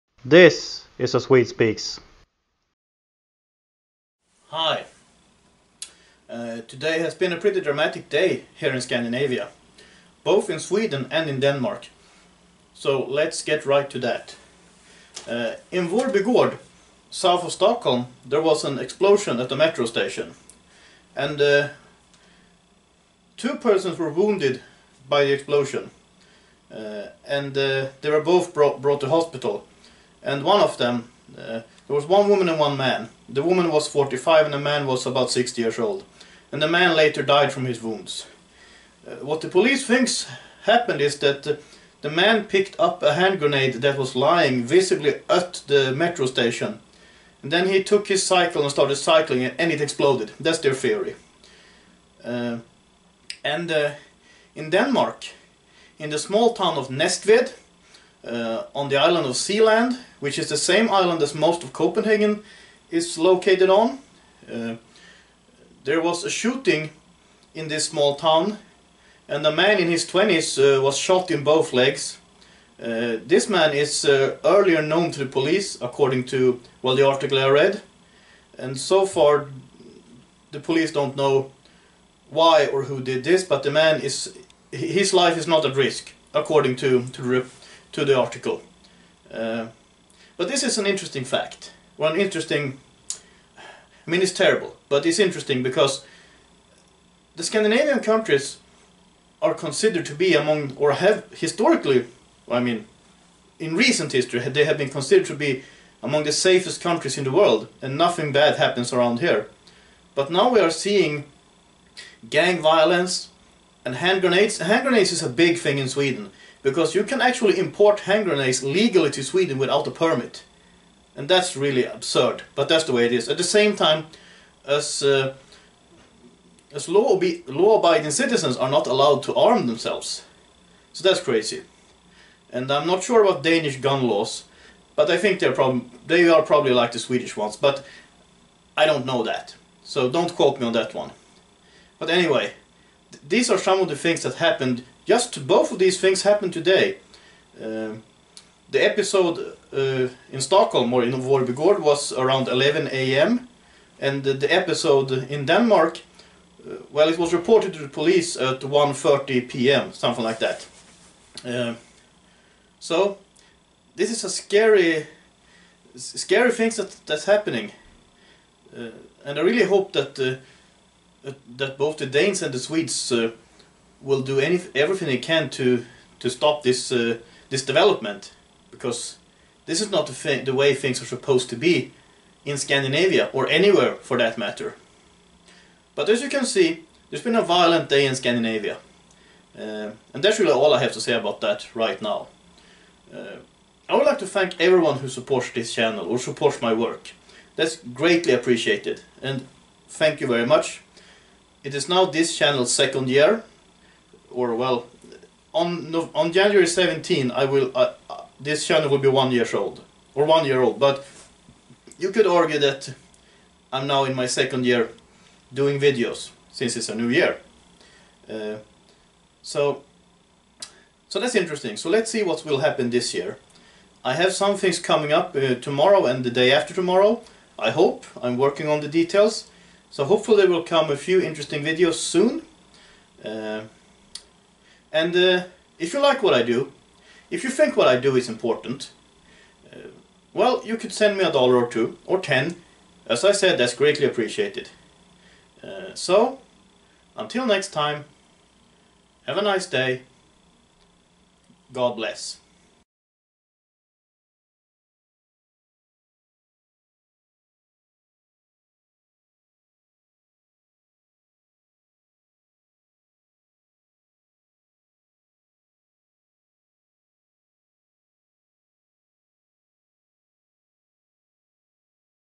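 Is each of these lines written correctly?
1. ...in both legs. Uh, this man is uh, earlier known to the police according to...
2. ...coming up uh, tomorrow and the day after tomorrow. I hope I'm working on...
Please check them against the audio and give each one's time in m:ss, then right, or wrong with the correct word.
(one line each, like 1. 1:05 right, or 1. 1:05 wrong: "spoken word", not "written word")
1. 1:11 right
2. 3:44 right.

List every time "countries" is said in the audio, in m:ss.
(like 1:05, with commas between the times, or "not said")
1:37, 1:46.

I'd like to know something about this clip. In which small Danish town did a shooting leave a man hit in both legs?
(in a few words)
Næstved.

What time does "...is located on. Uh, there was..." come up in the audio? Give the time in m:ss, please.
1:02.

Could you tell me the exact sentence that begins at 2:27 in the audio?
Uh, the episode uh, in Stockholm or in Vårbygård was around 11 a.m.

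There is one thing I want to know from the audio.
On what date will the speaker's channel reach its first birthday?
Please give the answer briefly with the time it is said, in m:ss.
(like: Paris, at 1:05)
January 17, at 3:26.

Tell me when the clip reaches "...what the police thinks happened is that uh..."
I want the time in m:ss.
0:39.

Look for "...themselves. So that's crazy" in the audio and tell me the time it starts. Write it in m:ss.
2:09.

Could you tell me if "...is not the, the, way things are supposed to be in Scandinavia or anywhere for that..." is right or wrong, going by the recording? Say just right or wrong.
right.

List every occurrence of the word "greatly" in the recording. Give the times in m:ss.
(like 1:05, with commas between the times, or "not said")
3:17, 4:03.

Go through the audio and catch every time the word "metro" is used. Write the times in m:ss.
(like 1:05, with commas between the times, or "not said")
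0:19, 0:45.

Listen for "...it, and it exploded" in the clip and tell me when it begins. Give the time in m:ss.
0:49.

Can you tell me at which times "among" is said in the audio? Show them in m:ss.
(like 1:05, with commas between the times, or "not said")
1:40, 1:46.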